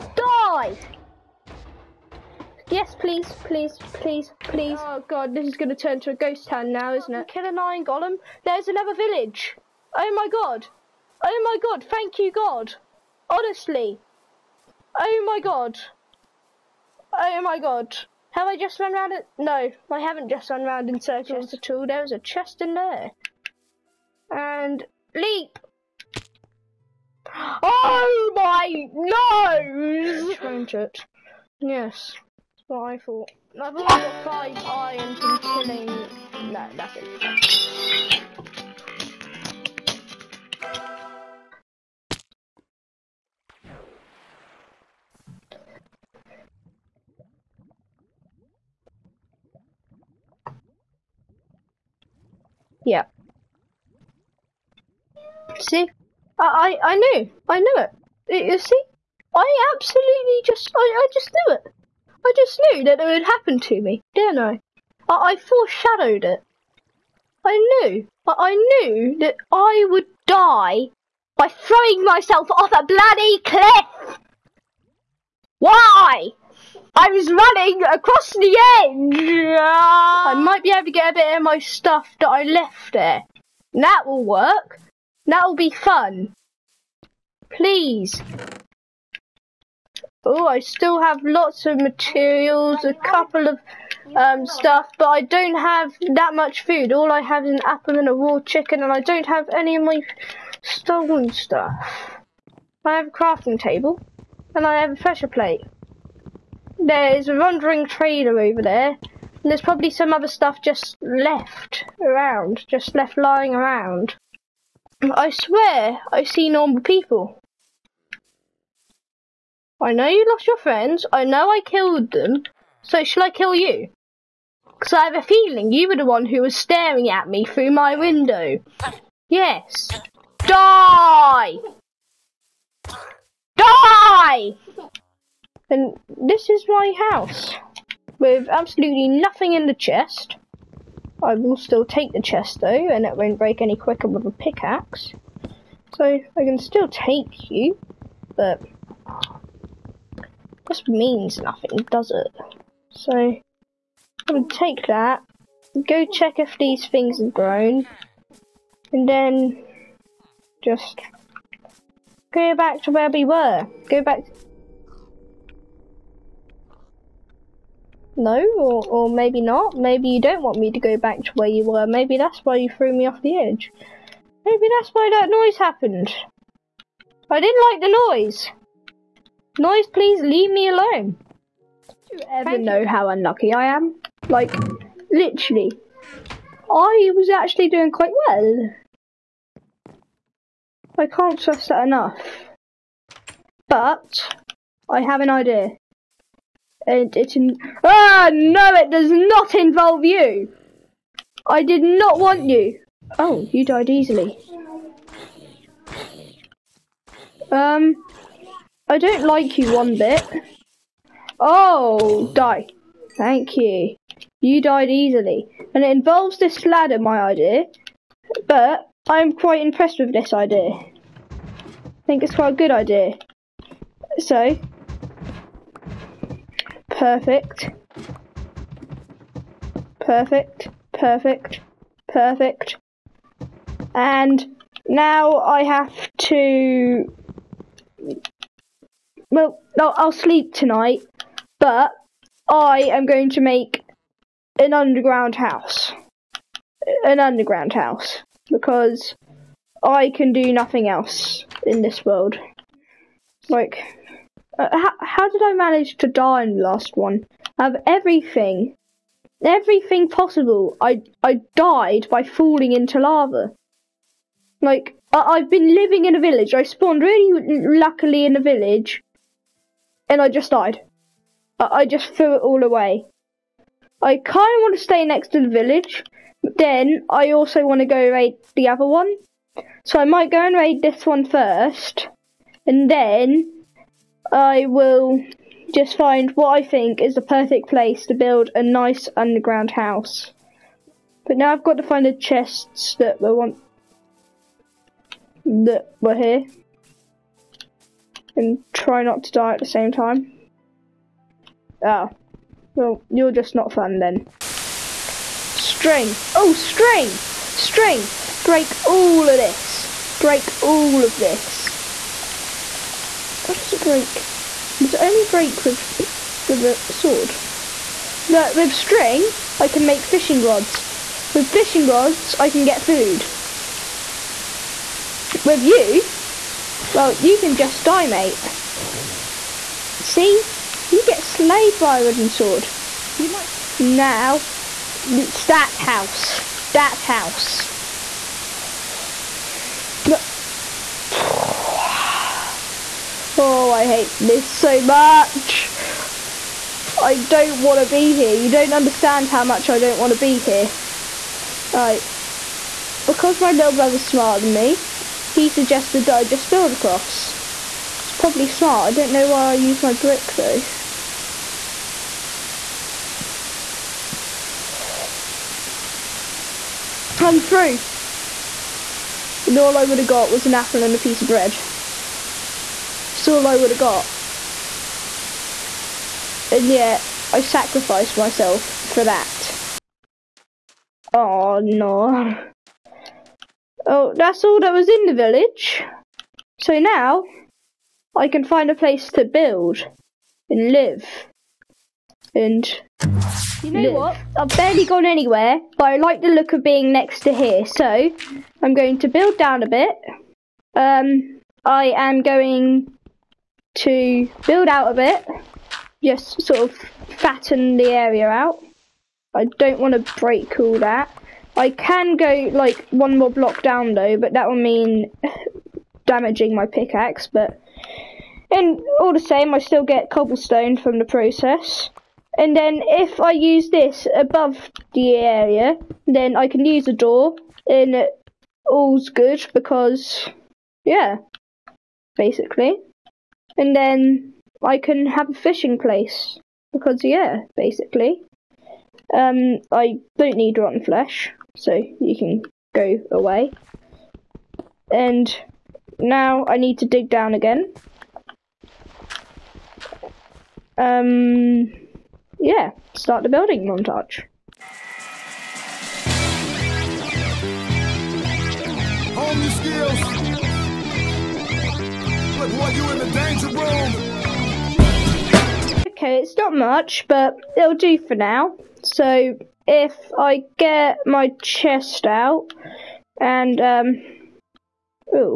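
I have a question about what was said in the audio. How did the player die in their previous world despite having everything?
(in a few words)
Falling into lava.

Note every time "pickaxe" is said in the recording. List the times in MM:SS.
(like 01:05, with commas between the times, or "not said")
02:24, 06:56.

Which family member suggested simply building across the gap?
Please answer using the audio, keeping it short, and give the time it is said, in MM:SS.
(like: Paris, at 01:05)
Little brother, at 05:53.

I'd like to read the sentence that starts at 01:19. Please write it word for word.
I might be able to get a bit of my stuff that I left there.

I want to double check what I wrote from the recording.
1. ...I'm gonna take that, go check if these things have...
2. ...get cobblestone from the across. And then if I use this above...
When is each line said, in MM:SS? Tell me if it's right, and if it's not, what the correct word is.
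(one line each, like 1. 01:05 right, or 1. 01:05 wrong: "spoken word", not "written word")
1. 02:33 right
2. 06:59 wrong: "process", not "across".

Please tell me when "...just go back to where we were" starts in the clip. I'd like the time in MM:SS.
02:40.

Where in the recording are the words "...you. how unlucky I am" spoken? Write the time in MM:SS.
03:02.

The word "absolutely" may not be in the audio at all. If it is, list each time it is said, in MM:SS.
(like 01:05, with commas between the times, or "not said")
00:59, 02:18.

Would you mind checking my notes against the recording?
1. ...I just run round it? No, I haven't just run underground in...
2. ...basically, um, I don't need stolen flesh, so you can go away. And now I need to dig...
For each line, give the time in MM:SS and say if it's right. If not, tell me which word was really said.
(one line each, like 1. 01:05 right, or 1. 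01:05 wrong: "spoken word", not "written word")
1. 00:18 wrong: "round", not "underground"
2. 07:17 wrong: "rotten", not "stolen".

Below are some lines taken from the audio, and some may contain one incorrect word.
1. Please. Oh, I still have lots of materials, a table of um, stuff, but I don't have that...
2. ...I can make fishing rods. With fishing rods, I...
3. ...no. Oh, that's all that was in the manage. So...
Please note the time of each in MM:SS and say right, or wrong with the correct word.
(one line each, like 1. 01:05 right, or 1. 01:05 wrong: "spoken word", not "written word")
1. 01:27 wrong: "couple", not "table"
2. 05:19 right
3. 06:21 wrong: "village", not "manage".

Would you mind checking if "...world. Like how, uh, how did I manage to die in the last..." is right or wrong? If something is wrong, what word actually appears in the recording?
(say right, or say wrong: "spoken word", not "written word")
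right.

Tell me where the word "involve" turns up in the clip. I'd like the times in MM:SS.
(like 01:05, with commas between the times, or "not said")
03:19, 03:35.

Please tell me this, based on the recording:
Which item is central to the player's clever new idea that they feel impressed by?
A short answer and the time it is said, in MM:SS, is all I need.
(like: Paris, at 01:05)
Ladder, at 03:36.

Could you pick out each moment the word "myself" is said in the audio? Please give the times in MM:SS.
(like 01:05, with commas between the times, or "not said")
01:12, 06:18.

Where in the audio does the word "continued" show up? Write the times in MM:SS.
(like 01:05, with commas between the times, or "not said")
not said.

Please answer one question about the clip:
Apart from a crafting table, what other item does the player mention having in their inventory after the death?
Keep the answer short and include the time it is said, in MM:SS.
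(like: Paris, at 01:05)
A pressure plate, at 01:44.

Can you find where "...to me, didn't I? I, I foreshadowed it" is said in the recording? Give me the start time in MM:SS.
01:03.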